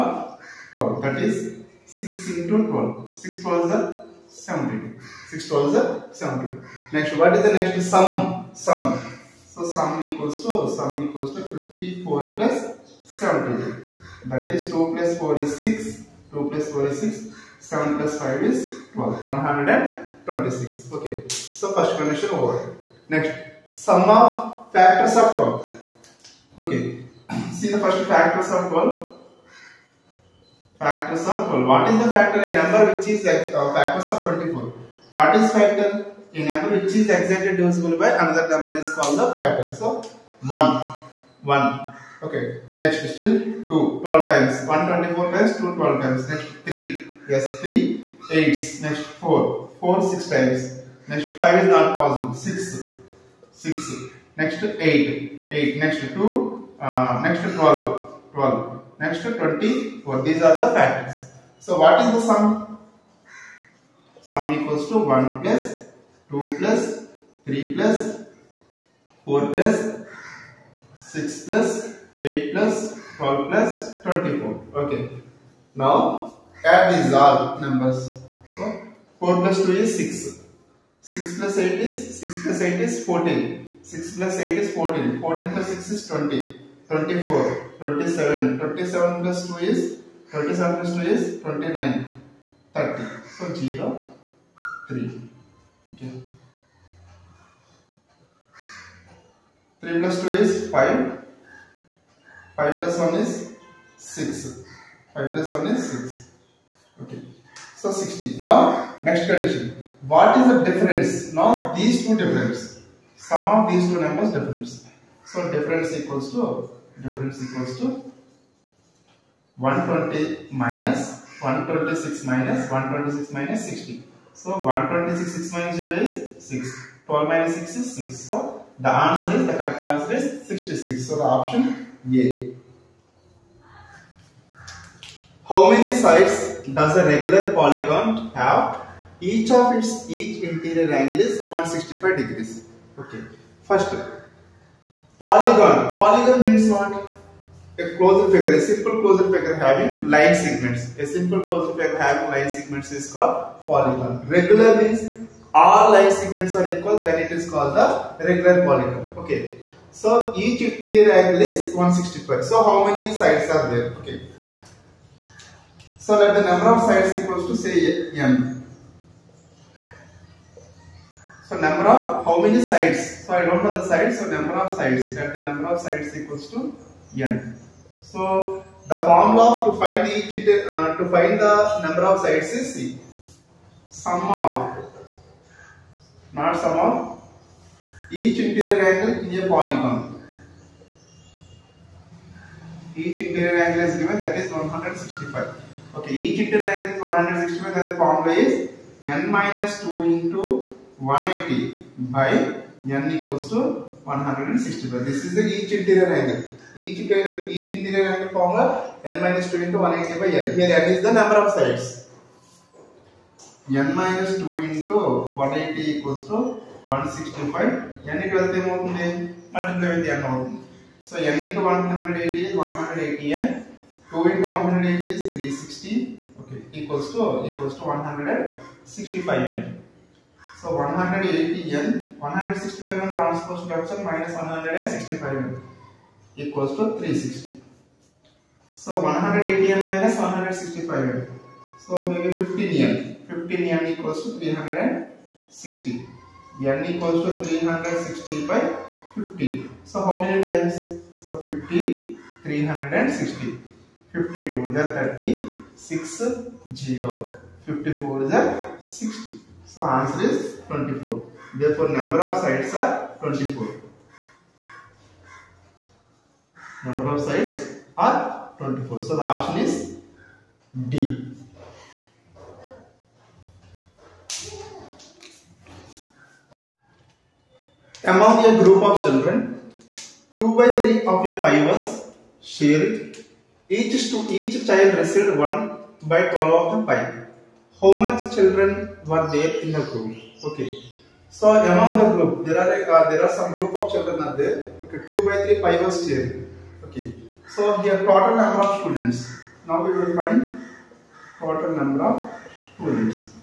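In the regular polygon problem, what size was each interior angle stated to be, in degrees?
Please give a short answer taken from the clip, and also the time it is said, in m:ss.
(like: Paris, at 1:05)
165, at 2:21.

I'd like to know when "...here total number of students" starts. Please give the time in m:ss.
4:57.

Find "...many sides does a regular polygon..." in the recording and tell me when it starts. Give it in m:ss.
2:15.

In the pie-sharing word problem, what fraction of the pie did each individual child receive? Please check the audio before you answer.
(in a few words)
1/12.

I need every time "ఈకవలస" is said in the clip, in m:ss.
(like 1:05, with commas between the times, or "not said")
3:23, 3:35.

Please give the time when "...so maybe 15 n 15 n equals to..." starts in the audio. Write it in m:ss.
4:01.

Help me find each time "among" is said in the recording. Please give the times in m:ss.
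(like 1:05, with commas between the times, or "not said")
4:38, 4:51.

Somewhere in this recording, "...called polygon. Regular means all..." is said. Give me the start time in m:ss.
2:33.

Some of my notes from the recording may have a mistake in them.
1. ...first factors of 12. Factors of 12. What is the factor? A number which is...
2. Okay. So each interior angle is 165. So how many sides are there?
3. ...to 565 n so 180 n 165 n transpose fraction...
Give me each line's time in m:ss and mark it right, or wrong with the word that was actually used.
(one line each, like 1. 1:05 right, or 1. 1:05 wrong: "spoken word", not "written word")
1. 0:27 right
2. 2:39 right
3. 3:47 wrong: "165", not "565".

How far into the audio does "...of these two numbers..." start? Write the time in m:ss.
1:53.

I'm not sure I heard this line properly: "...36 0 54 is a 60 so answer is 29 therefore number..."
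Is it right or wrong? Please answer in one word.
wrong.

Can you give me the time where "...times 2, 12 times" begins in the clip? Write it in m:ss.
0:45.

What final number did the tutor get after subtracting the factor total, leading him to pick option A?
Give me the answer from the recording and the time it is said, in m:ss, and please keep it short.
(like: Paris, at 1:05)
66, at 2:09.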